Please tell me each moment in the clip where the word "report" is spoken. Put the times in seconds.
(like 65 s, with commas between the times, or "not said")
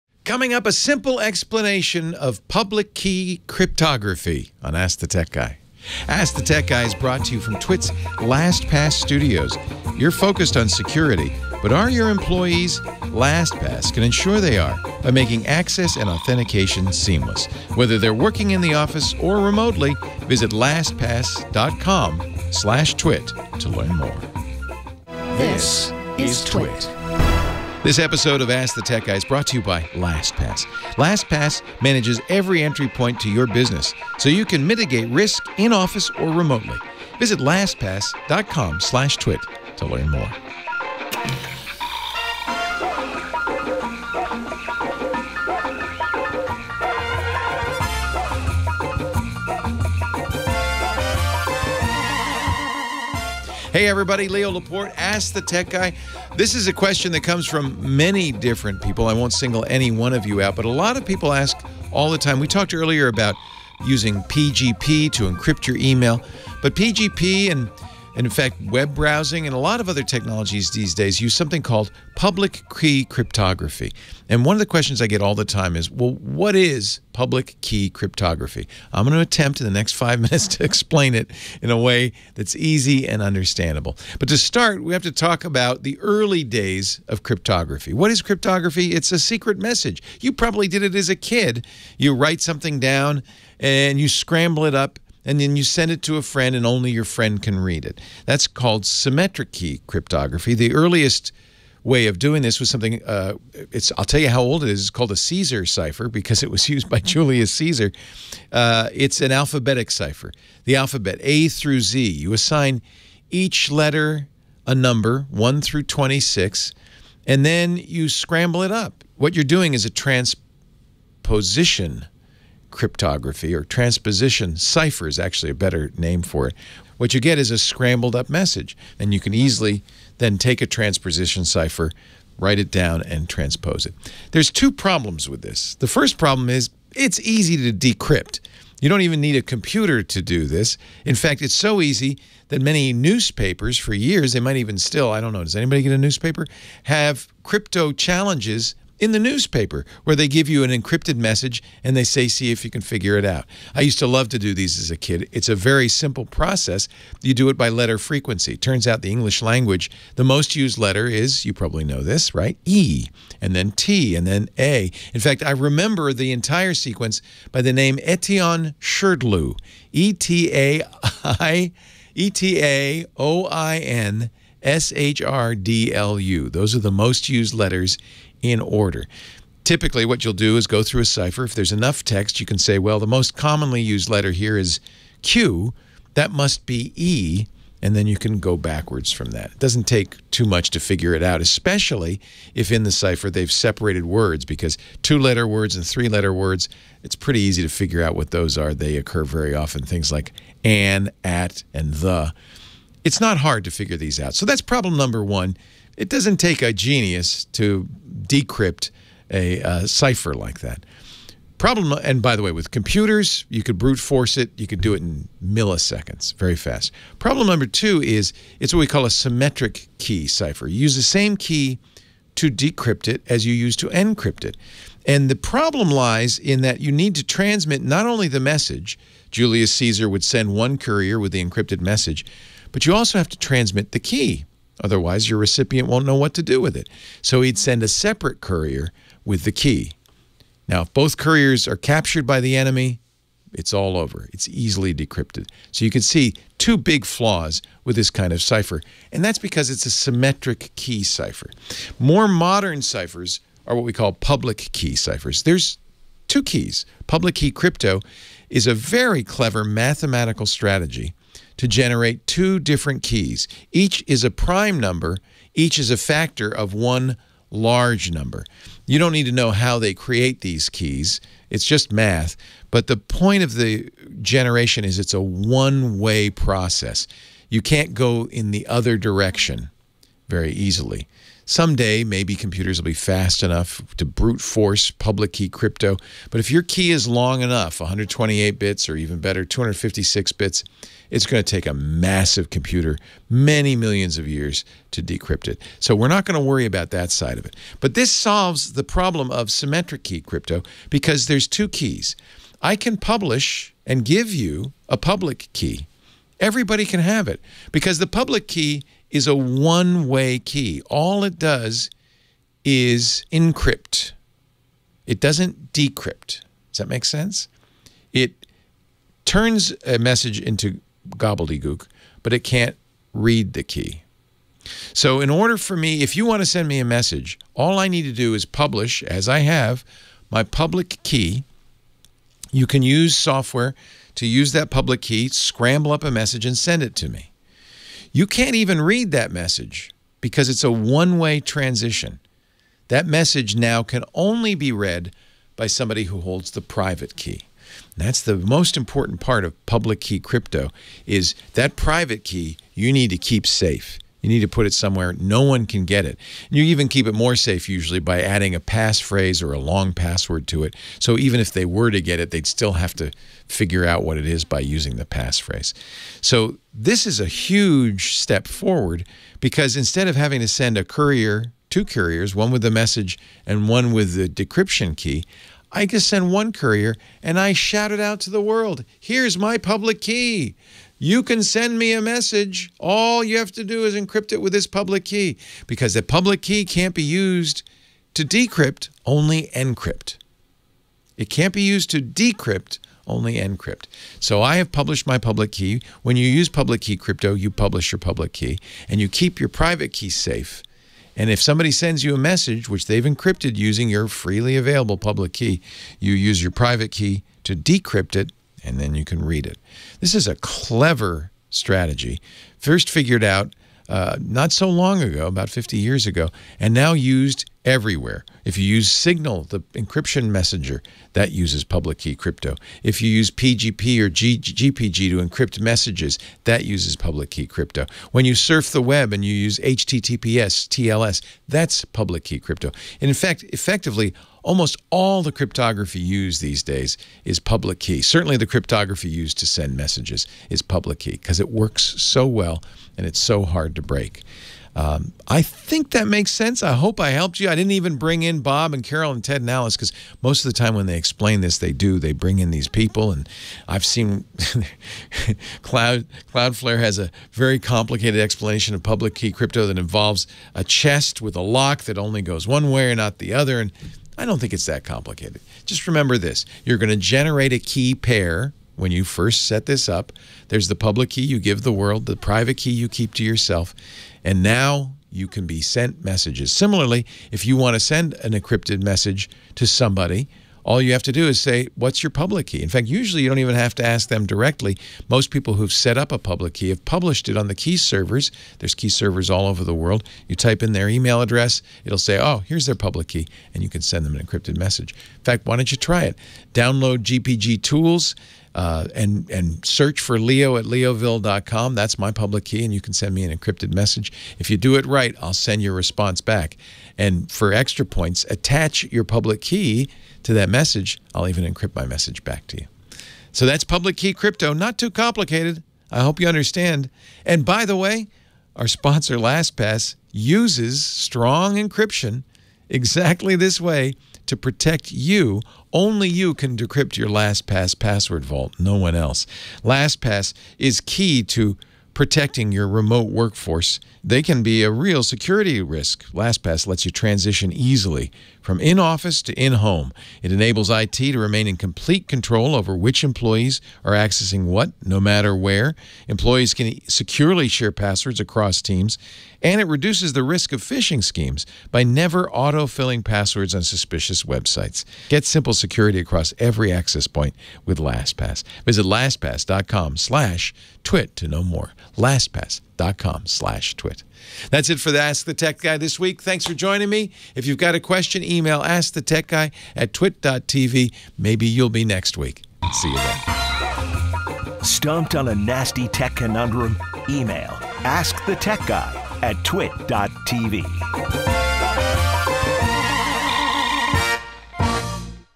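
not said.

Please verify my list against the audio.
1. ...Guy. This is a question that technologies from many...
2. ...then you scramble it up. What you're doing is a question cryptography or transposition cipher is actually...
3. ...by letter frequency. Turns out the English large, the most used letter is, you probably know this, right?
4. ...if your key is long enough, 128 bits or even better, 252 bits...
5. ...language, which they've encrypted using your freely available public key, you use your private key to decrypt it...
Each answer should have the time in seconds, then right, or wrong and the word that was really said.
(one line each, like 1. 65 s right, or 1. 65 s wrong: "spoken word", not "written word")
1. 55 s wrong: "comes", not "technologies"
2. 117 s wrong: "transposition", not "question"
3. 157 s wrong: "language", not "large"
4. 286 s wrong: "256", not "252"
5. 402 s wrong: "message", not "language".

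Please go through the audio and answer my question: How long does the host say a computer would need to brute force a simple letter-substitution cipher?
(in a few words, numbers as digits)
milliseconds.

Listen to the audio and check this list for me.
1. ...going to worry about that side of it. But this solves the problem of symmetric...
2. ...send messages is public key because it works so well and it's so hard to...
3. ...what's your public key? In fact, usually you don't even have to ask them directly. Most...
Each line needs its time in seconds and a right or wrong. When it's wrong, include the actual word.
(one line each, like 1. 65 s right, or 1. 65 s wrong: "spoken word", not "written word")
1. 296 s right
2. 439 s right
3. 481 s right.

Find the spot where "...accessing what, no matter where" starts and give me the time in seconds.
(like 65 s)
543 s.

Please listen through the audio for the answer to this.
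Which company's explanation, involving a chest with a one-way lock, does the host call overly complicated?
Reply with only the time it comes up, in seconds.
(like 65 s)
456 s.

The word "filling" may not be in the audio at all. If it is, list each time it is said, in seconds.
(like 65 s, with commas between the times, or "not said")
552 s.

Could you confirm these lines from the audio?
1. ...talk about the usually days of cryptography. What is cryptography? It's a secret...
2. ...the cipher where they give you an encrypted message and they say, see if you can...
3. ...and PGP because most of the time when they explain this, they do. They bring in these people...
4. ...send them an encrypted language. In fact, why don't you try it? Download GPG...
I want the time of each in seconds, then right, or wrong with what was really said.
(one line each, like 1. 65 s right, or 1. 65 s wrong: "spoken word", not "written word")
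1. 85 s wrong: "early", not "usually"
2. 149 s wrong: "newspaper", not "cipher"
3. 449 s wrong: "Alice", not "PGP"
4. 493 s wrong: "message", not "language".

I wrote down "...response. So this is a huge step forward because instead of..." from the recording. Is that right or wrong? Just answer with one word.
wrong.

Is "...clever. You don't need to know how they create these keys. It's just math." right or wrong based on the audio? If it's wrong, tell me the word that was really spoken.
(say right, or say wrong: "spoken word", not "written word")
wrong: "number", not "clever".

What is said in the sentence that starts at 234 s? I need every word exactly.
Otherwise, your recipient won't know what to do with it.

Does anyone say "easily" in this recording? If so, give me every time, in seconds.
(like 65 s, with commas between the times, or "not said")
129 s, 244 s, 280 s, 537 s.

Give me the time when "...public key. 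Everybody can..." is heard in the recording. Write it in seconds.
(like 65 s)
304 s.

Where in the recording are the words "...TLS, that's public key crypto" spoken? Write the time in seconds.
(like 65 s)
430 s.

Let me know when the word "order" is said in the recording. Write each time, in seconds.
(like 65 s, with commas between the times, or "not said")
178 s, 325 s.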